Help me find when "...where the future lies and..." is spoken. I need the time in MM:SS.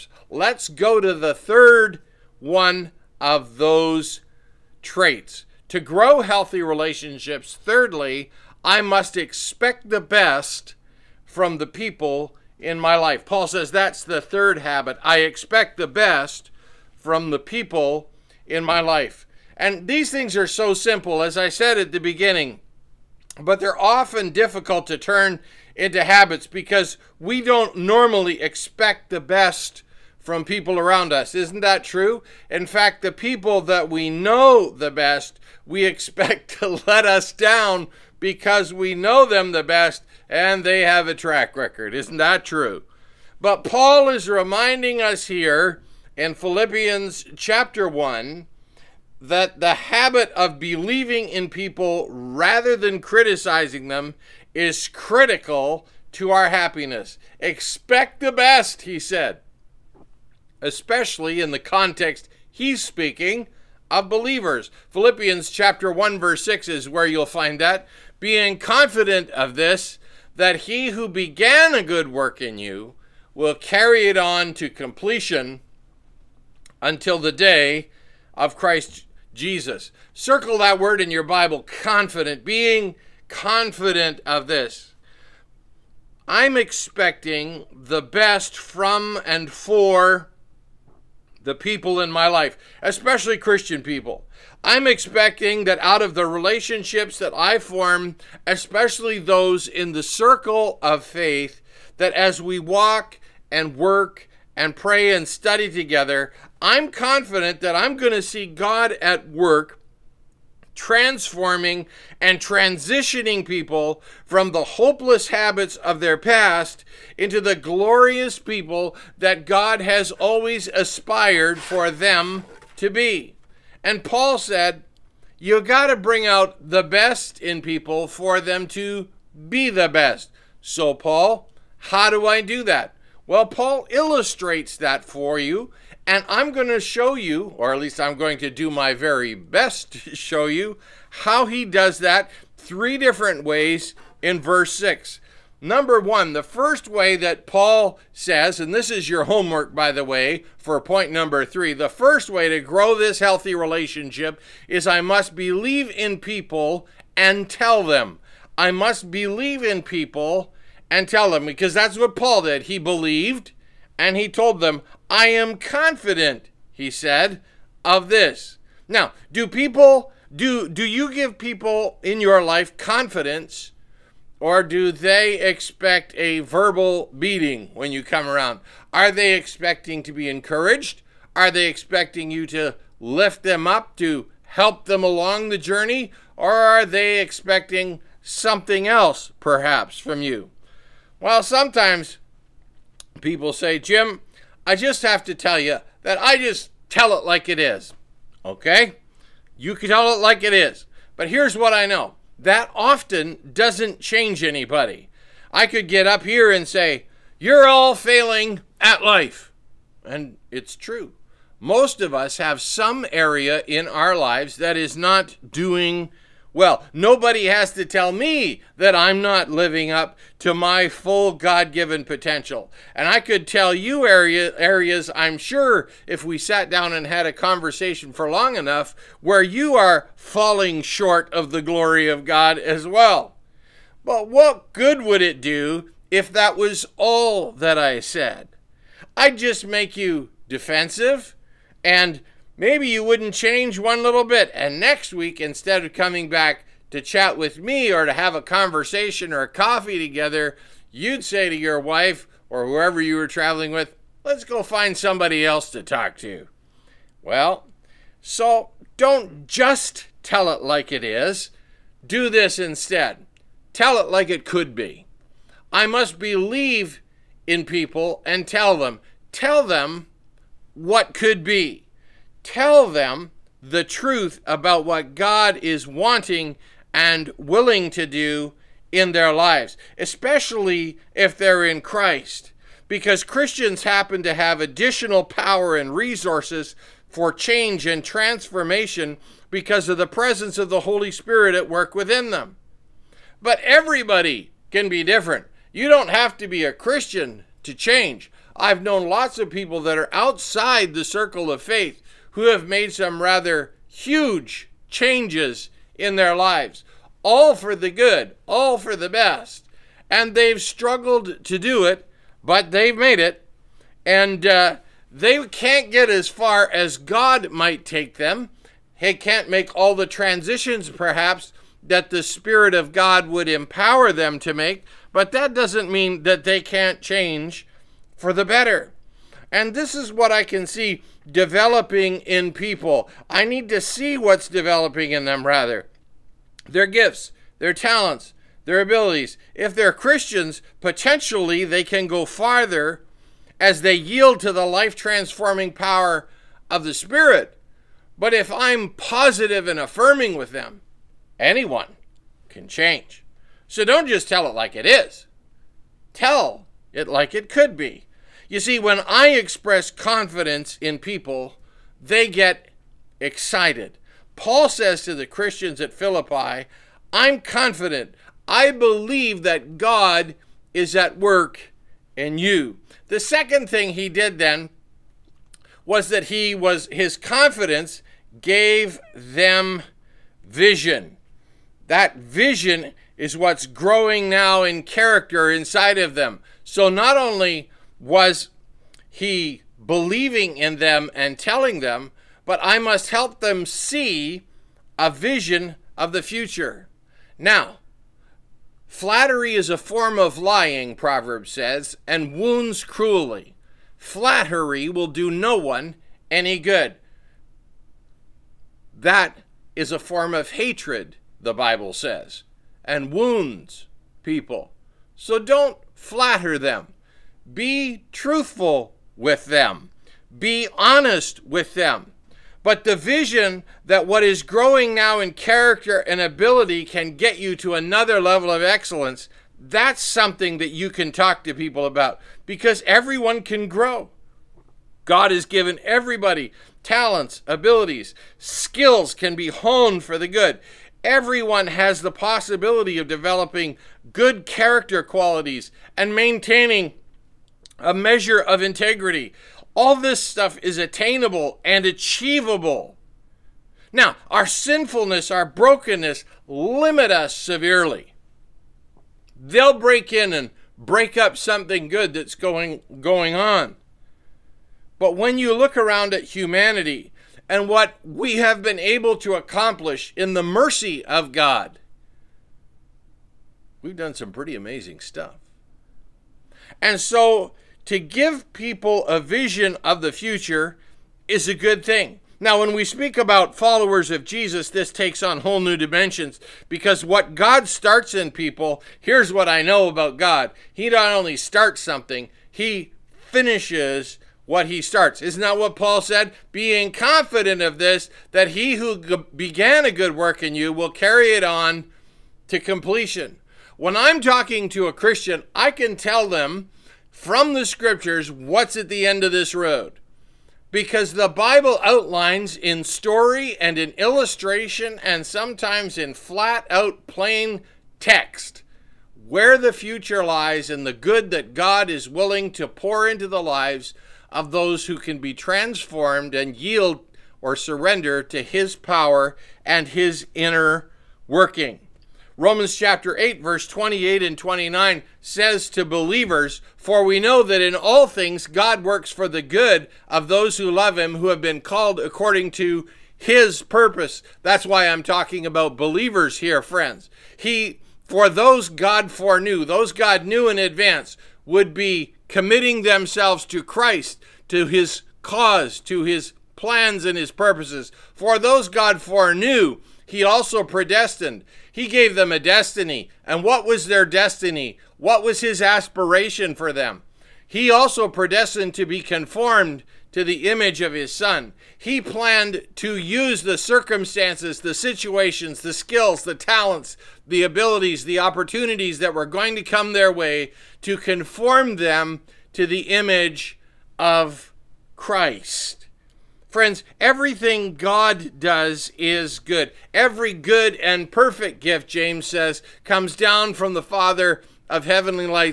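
08:39.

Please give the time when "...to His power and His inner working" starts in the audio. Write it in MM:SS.
08:48.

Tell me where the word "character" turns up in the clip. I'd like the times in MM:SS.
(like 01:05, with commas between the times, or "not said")
06:24, 07:05, 07:24.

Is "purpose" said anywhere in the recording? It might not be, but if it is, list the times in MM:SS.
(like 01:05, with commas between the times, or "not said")
09:03, 09:17.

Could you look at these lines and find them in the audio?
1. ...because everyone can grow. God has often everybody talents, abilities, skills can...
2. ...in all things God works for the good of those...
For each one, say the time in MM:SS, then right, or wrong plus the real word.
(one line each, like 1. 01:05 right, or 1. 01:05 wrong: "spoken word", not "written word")
1. 07:12 wrong: "given", not "often"
2. 08:57 right.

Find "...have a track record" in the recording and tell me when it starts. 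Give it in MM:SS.
00:40.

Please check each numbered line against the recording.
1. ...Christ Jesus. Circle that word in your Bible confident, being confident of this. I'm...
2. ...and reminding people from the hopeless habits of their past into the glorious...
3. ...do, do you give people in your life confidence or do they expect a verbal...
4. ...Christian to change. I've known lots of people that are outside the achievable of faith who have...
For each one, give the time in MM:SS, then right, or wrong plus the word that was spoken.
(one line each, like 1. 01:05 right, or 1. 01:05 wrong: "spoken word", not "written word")
1. 01:18 right
2. 01:52 wrong: "transitioning", not "reminding"
3. 02:50 right
4. 04:56 wrong: "circle", not "achievable".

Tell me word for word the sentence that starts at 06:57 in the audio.
Be truthful with them, be honest with them.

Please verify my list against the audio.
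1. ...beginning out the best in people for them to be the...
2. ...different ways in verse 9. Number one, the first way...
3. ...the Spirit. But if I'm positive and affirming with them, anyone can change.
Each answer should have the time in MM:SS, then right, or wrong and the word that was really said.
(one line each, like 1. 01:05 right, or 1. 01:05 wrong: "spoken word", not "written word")
1. 02:05 wrong: "bring", not "beginning"
2. 02:22 wrong: "6", not "9"
3. 05:46 right.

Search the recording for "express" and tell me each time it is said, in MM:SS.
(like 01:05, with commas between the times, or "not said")
05:59.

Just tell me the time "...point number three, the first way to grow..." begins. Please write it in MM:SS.
02:30.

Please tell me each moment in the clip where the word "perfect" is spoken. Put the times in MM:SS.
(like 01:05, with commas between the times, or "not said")
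09:51.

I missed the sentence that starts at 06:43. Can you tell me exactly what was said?
Flattery will do no one any good.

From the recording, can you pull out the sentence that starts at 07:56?
And so to give people a vision of the future is a good thing.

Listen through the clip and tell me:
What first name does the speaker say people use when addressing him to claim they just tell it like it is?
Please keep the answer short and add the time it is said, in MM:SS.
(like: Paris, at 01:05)
Jim, at 03:13.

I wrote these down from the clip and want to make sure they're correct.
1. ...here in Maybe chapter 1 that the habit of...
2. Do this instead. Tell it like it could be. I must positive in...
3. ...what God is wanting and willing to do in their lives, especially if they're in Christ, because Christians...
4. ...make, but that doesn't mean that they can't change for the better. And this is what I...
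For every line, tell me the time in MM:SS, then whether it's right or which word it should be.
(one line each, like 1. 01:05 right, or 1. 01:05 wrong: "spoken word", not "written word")
1. 00:45 wrong: "Philippians", not "Maybe"
2. 04:22 wrong: "believe", not "positive"
3. 04:34 right
4. 05:24 right.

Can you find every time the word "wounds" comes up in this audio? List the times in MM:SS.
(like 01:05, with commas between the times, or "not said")
06:42, 06:53.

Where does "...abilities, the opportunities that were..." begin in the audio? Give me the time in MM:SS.
09:37.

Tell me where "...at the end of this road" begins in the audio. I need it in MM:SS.
08:28.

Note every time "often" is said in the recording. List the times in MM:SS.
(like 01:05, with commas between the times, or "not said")
00:23, 03:22.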